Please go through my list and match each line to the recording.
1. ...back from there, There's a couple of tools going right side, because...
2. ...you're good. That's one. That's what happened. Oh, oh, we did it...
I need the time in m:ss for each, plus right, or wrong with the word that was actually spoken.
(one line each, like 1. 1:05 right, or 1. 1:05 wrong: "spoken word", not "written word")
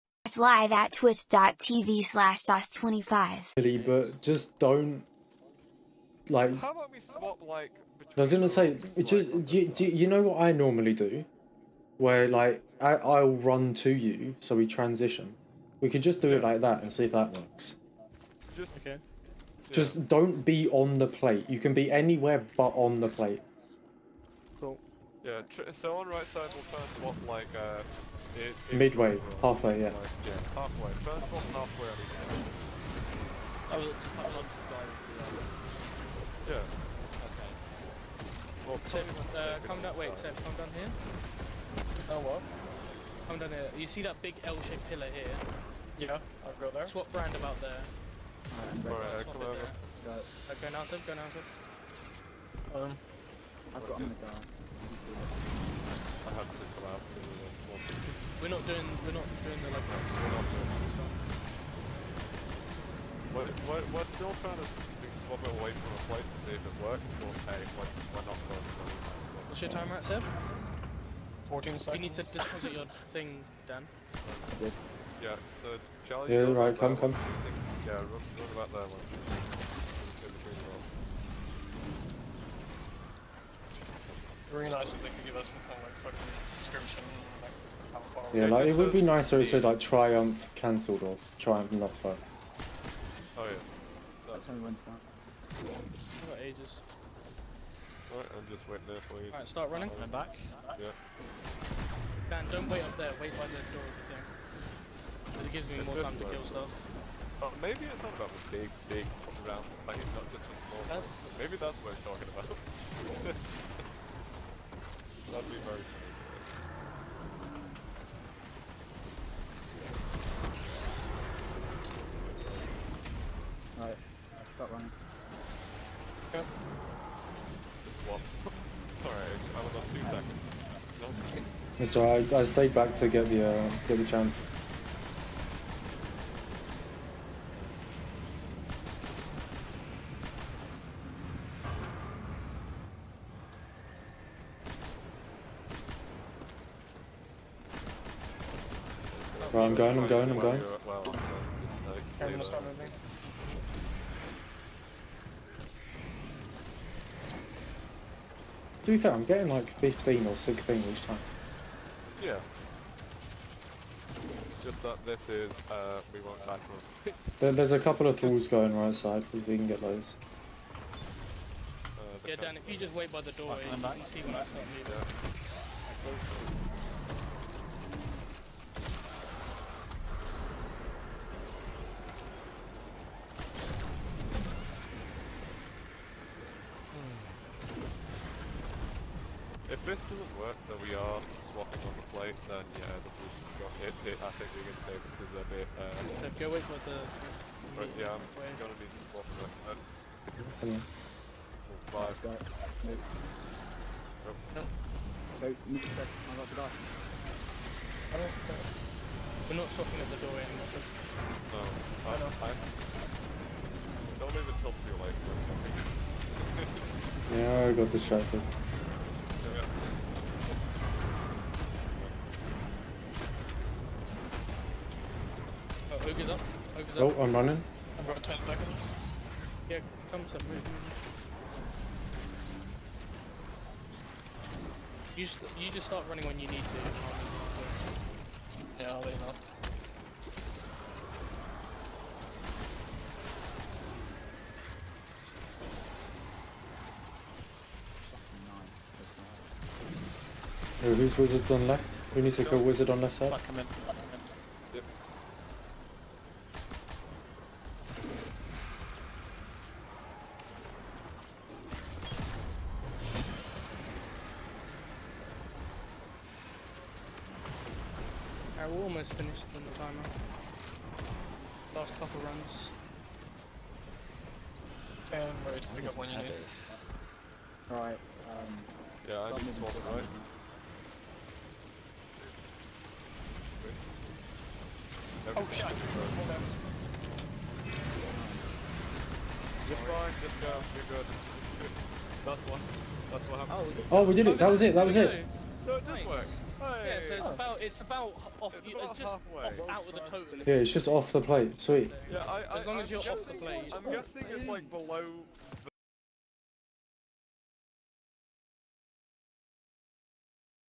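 1. 2:46 right
2. 4:50 right.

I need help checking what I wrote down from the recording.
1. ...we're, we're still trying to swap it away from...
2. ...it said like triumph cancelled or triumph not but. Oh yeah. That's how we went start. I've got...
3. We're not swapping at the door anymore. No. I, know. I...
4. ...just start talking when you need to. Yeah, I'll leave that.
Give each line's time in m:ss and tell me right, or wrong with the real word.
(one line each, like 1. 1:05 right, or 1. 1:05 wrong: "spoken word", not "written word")
1. 1:03 right
2. 1:29 right
3. 3:29 right
4. 3:55 wrong: "running", not "talking".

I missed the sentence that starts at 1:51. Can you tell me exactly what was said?
Maybe that's what it's talking about.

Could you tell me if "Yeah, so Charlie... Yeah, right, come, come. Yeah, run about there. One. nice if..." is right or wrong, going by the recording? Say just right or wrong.
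right.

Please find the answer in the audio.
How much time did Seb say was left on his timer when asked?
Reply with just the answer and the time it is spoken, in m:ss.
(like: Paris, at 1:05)
14 seconds, at 1:11.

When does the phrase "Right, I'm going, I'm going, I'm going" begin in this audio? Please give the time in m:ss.
2:29.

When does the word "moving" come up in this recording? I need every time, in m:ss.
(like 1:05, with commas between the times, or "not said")
2:54.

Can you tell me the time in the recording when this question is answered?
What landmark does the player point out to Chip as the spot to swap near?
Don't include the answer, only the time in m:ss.
0:44.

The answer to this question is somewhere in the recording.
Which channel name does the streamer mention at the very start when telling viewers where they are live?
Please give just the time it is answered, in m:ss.
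0:02.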